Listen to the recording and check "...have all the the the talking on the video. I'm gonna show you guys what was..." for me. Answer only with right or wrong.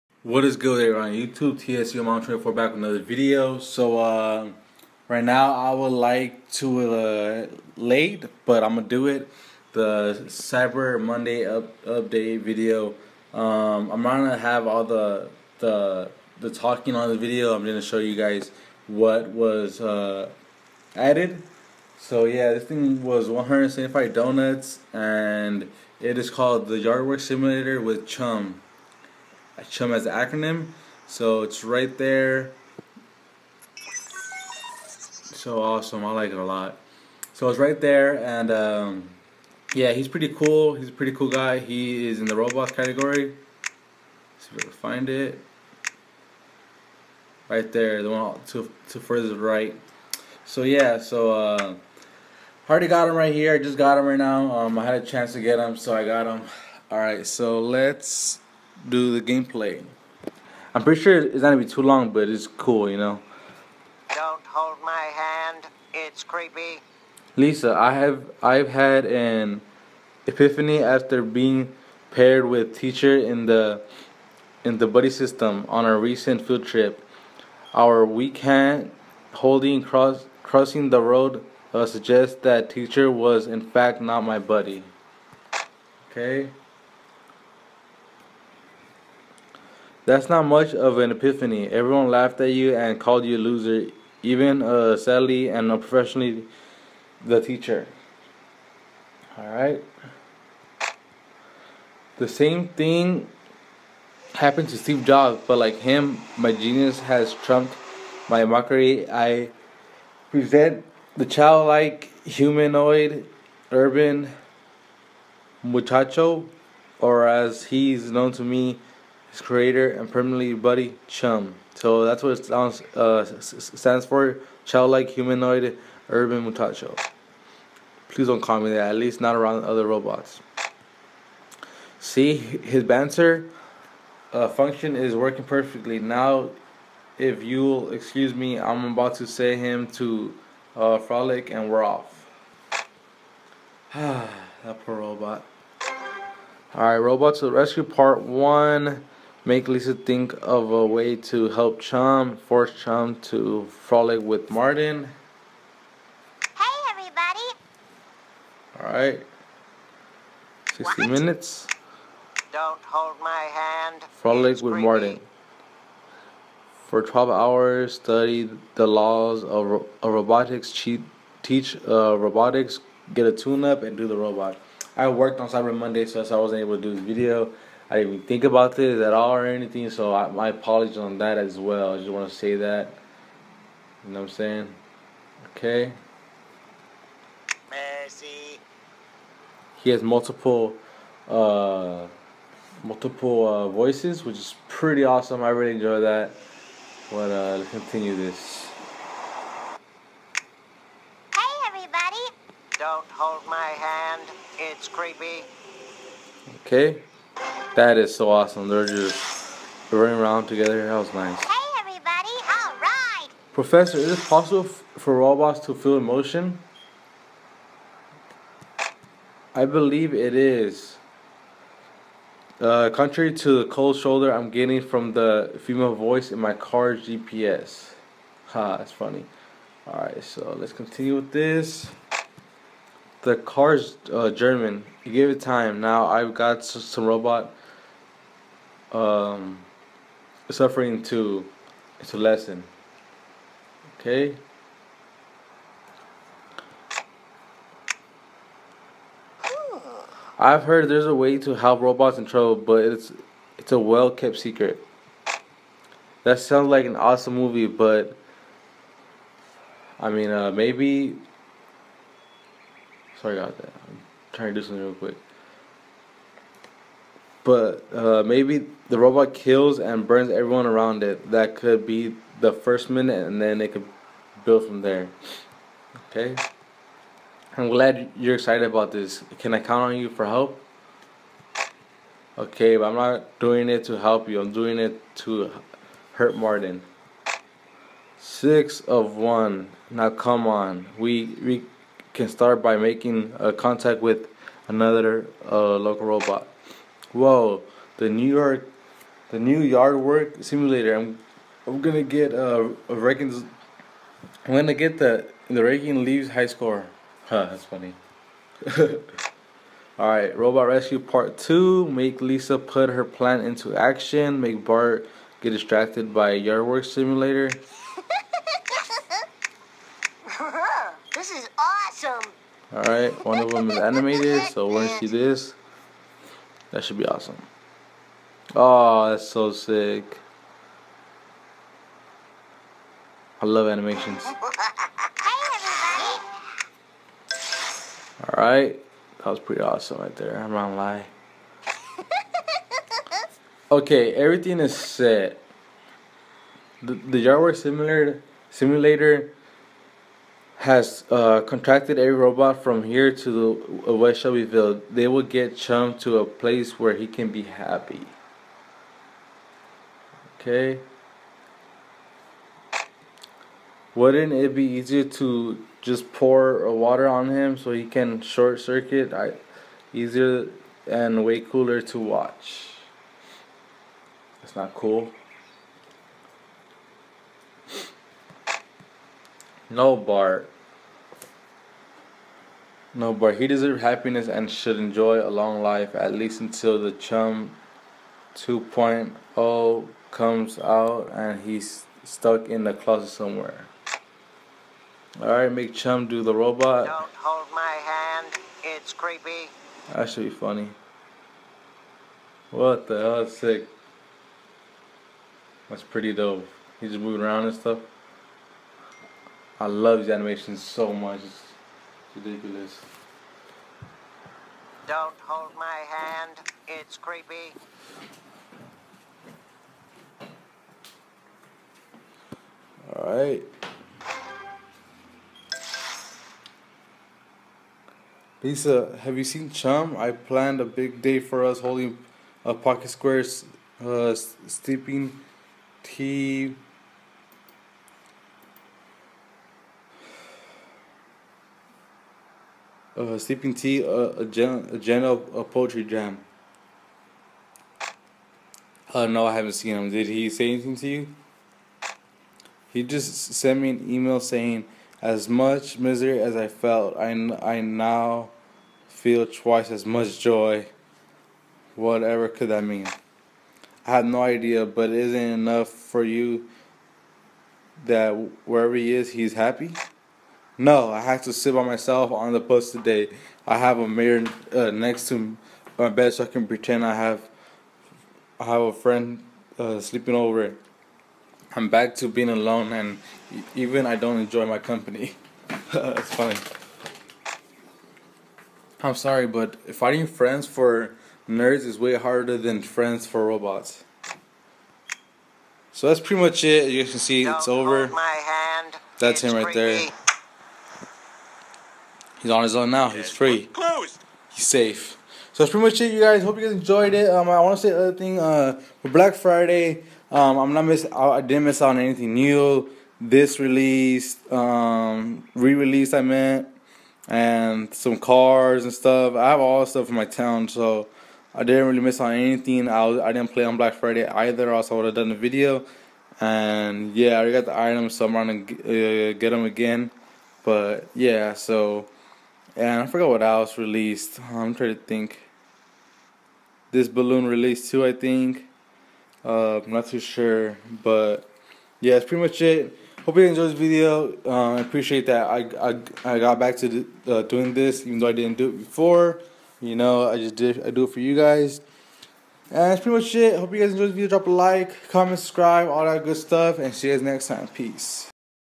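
right.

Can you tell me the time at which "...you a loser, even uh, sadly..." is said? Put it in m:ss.
1:33.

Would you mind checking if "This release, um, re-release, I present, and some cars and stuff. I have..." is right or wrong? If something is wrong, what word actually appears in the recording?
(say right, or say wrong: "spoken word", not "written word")
wrong: "meant", not "present".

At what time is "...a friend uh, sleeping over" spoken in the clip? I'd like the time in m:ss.
7:58.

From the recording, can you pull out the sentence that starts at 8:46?
And yeah, I got the items, so I'm gonna uh, get them again.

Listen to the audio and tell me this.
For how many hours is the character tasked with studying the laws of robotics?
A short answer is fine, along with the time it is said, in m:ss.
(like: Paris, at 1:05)
12, at 2:47.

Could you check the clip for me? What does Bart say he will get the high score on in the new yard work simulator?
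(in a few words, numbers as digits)
raking leaves.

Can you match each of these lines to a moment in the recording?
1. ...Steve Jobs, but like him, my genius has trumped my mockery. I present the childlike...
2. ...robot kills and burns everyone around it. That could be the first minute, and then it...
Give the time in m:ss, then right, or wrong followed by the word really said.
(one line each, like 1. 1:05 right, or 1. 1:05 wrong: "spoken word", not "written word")
1. 1:44 right
2. 4:28 right.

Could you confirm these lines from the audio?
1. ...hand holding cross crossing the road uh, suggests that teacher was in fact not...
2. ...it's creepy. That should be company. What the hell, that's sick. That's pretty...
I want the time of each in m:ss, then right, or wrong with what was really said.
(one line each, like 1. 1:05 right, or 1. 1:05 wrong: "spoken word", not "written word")
1. 1:18 right
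2. 6:38 wrong: "funny", not "company".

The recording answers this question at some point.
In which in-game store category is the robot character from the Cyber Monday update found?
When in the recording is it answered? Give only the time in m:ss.
0:42.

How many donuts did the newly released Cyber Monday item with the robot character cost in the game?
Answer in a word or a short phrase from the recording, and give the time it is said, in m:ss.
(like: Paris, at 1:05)
175, at 0:23.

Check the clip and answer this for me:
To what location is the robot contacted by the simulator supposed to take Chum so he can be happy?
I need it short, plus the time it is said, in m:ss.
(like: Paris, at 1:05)
West Shelbyville, at 5:53.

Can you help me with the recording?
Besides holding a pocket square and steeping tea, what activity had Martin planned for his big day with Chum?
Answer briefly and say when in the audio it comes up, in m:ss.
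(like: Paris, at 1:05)
poetry jam, at 7:25.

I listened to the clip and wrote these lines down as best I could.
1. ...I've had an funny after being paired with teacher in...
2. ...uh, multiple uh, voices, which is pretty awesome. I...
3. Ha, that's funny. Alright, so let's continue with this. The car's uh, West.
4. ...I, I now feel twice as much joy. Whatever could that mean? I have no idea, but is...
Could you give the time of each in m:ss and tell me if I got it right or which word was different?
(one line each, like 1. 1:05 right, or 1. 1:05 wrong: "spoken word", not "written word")
1. 1:08 wrong: "epiphany", not "funny"
2. 3:11 right
3. 3:48 wrong: "German", not "West"
4. 7:36 right.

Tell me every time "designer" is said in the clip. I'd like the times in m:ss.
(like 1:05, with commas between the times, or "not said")
not said.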